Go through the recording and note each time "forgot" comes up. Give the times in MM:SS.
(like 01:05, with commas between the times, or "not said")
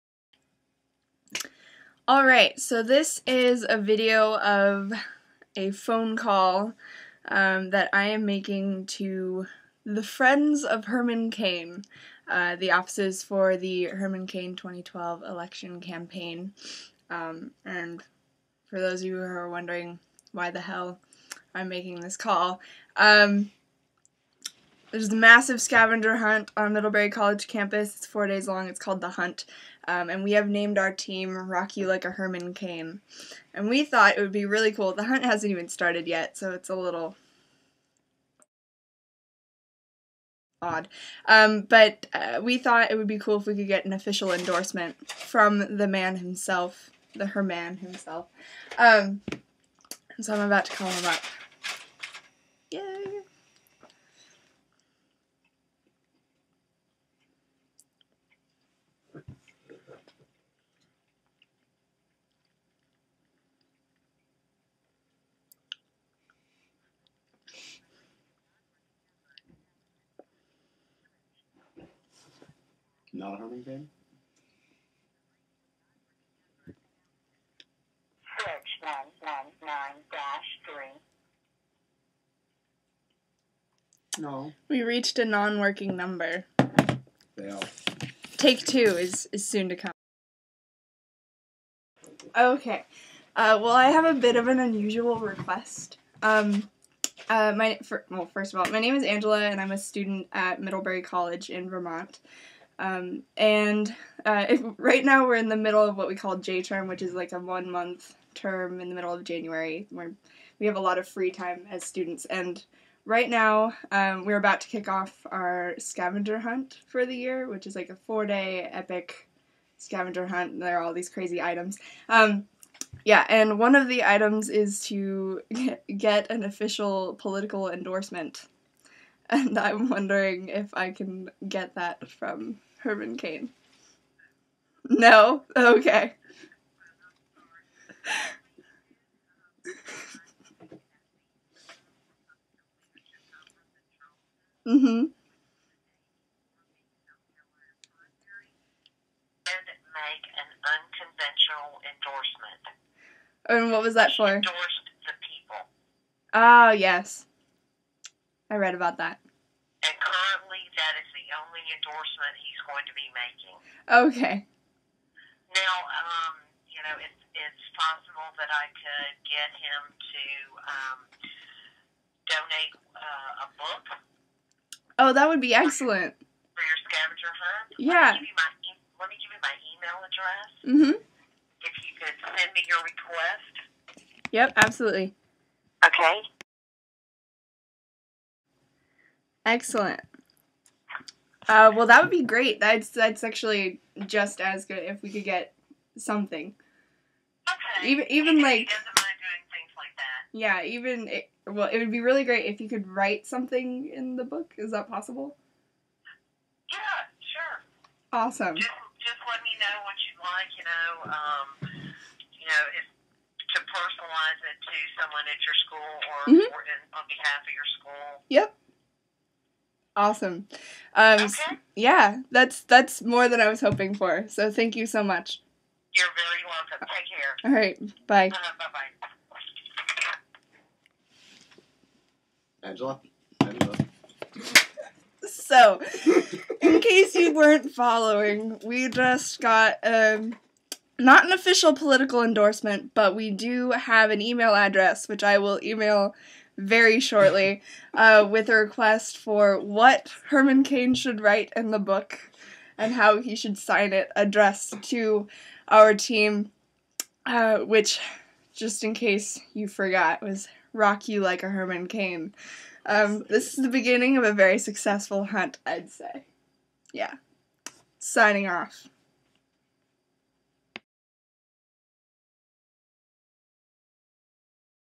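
04:19.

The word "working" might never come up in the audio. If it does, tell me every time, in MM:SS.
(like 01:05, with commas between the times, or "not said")
01:25.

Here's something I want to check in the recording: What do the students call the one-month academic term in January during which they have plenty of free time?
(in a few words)
J term.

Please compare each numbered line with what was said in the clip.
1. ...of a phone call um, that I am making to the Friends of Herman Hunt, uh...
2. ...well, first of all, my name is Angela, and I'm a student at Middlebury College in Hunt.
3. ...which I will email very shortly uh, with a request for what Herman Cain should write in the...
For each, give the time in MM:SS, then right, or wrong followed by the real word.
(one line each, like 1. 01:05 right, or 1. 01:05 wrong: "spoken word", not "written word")
1. 00:04 wrong: "Cain", not "Hunt"
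2. 01:38 wrong: "Vermont", not "Hunt"
3. 04:05 right.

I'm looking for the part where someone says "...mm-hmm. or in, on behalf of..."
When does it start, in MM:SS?
03:36.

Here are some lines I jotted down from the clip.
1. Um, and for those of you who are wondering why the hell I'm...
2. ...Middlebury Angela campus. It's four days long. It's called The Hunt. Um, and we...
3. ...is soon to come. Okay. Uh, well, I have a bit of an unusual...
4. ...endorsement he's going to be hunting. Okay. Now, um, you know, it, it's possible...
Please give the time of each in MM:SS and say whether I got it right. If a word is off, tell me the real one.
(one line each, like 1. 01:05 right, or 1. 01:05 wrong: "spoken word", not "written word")
1. 00:17 right
2. 00:26 wrong: "College", not "Angela"
3. 01:29 right
4. 02:41 wrong: "making", not "hunting".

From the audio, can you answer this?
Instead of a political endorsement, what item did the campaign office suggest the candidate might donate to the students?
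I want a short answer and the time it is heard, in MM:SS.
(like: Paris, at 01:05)
A book, at 02:53.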